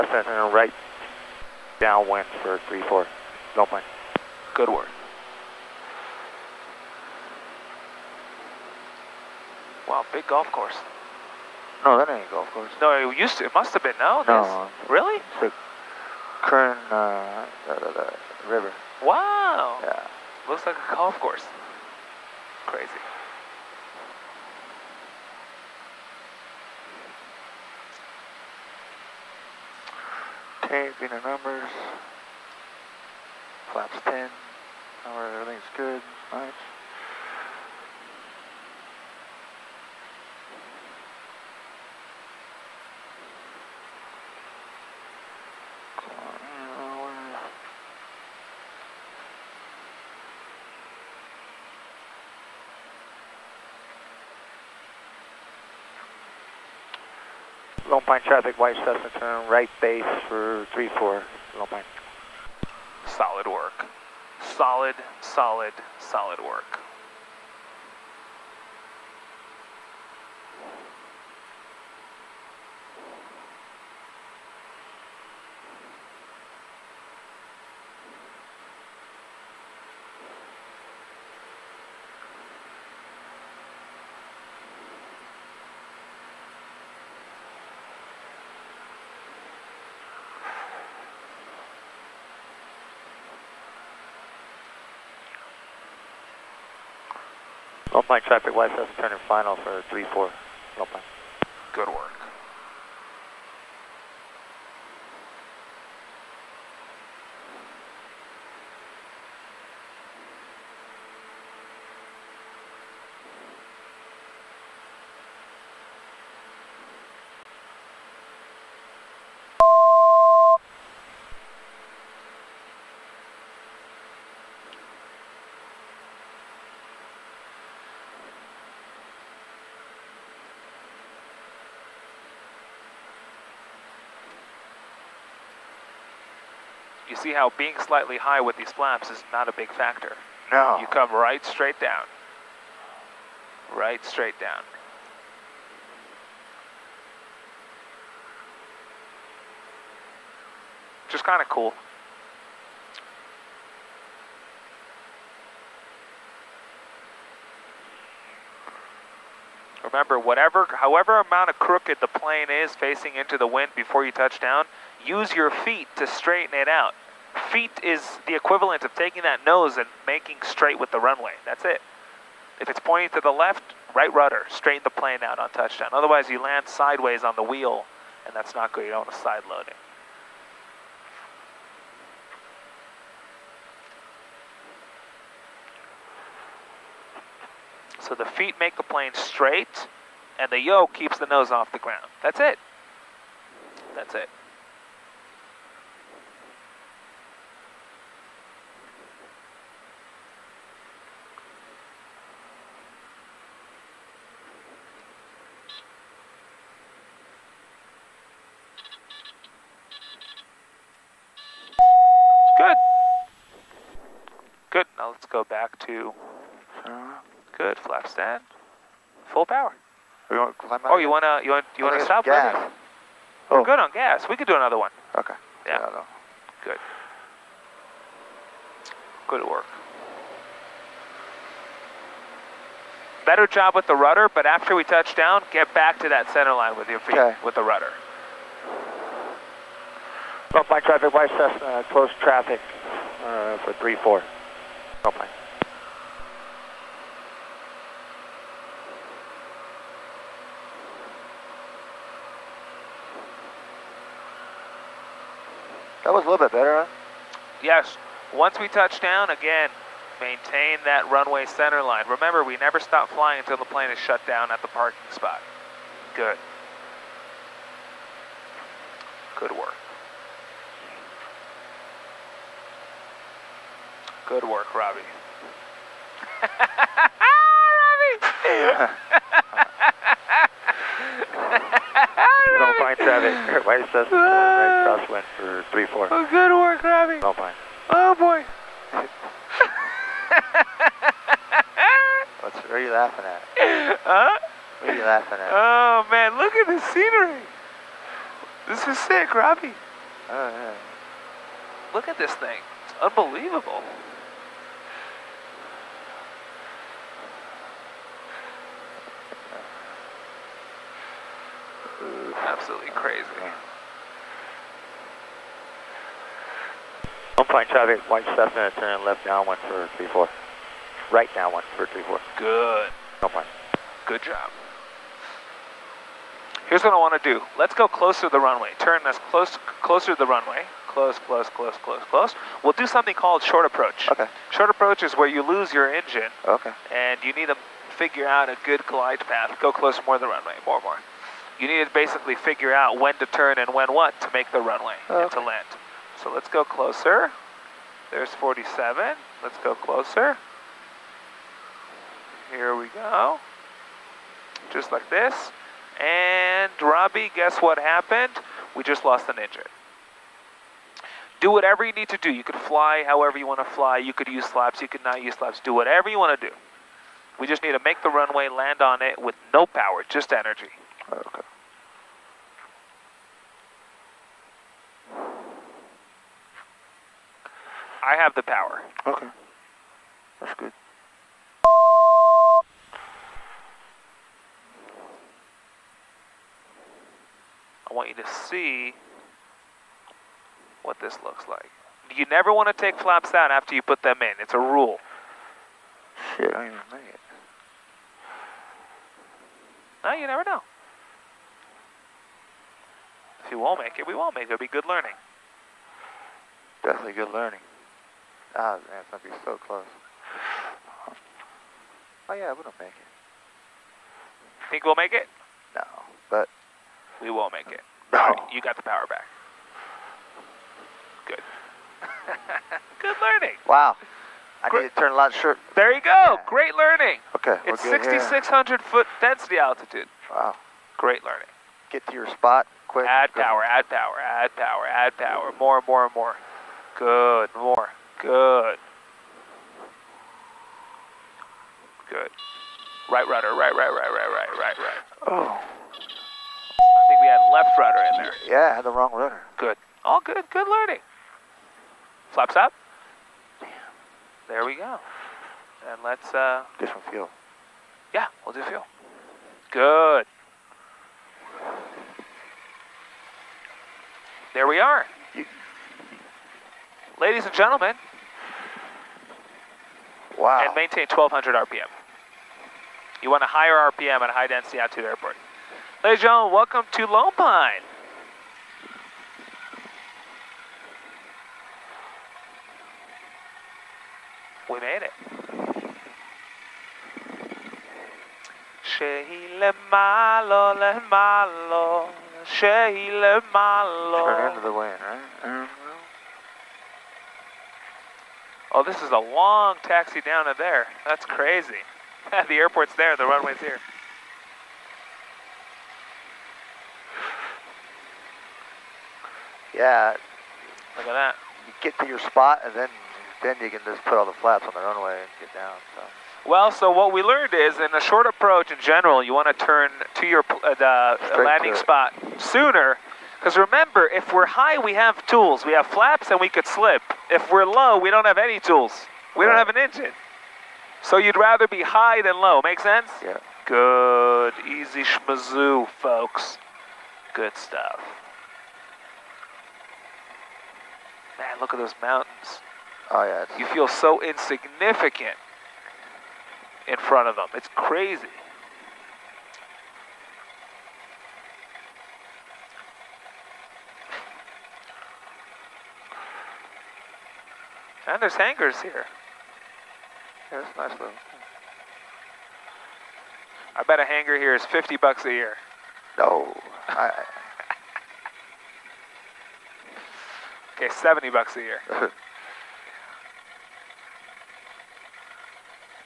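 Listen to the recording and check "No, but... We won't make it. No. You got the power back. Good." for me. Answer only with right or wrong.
right.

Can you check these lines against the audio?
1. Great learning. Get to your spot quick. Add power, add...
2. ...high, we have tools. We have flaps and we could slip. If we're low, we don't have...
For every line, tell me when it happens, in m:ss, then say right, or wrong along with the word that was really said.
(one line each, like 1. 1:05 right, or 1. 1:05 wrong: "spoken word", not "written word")
1. 7:10 right
2. 8:44 right.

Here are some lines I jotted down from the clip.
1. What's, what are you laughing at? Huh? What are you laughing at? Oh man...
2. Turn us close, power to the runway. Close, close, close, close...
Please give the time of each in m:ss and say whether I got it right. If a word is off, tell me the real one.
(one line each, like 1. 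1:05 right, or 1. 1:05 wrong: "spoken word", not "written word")
1. 4:52 right
2. 5:28 wrong: "closer", not "power".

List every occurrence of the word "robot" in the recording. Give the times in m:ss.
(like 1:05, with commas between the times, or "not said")
not said.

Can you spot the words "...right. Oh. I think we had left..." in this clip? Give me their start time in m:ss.
7:24.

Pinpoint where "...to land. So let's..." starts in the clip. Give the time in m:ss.
5:45.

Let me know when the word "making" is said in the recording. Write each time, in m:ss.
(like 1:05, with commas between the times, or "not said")
2:50.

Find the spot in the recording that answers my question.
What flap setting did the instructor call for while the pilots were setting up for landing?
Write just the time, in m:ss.
0:33.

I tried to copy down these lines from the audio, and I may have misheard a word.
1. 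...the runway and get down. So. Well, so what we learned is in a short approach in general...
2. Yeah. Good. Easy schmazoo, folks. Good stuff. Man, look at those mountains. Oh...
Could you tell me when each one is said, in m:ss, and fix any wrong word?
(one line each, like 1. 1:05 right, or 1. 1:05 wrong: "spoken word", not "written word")
1. 8:34 right
2. 8:53 right.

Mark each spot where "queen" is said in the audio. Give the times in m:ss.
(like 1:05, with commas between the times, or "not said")
not said.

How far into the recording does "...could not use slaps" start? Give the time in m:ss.
6:04.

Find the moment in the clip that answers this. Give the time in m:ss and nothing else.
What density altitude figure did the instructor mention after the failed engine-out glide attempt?
7:07.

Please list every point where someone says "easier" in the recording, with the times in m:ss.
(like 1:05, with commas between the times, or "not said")
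not said.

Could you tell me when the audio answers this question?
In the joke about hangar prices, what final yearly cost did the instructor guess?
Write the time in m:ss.
9:30.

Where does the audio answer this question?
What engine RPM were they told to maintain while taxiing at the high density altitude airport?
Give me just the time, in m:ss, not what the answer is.
7:51.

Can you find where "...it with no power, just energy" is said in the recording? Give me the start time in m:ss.
6:09.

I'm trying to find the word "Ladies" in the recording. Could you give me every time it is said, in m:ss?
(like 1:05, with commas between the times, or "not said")
7:47, 7:56.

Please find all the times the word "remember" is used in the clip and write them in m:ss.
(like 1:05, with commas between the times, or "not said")
2:39, 4:22, 8:43.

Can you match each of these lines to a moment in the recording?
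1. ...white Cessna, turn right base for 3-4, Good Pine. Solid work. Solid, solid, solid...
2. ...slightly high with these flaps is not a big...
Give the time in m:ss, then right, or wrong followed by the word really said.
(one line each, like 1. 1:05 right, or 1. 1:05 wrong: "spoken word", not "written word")
1. 0:58 wrong: "Lone", not "Good"
2. 2:17 right.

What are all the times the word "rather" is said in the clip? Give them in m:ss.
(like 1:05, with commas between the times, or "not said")
8:51.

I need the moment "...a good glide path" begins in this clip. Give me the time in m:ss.
5:38.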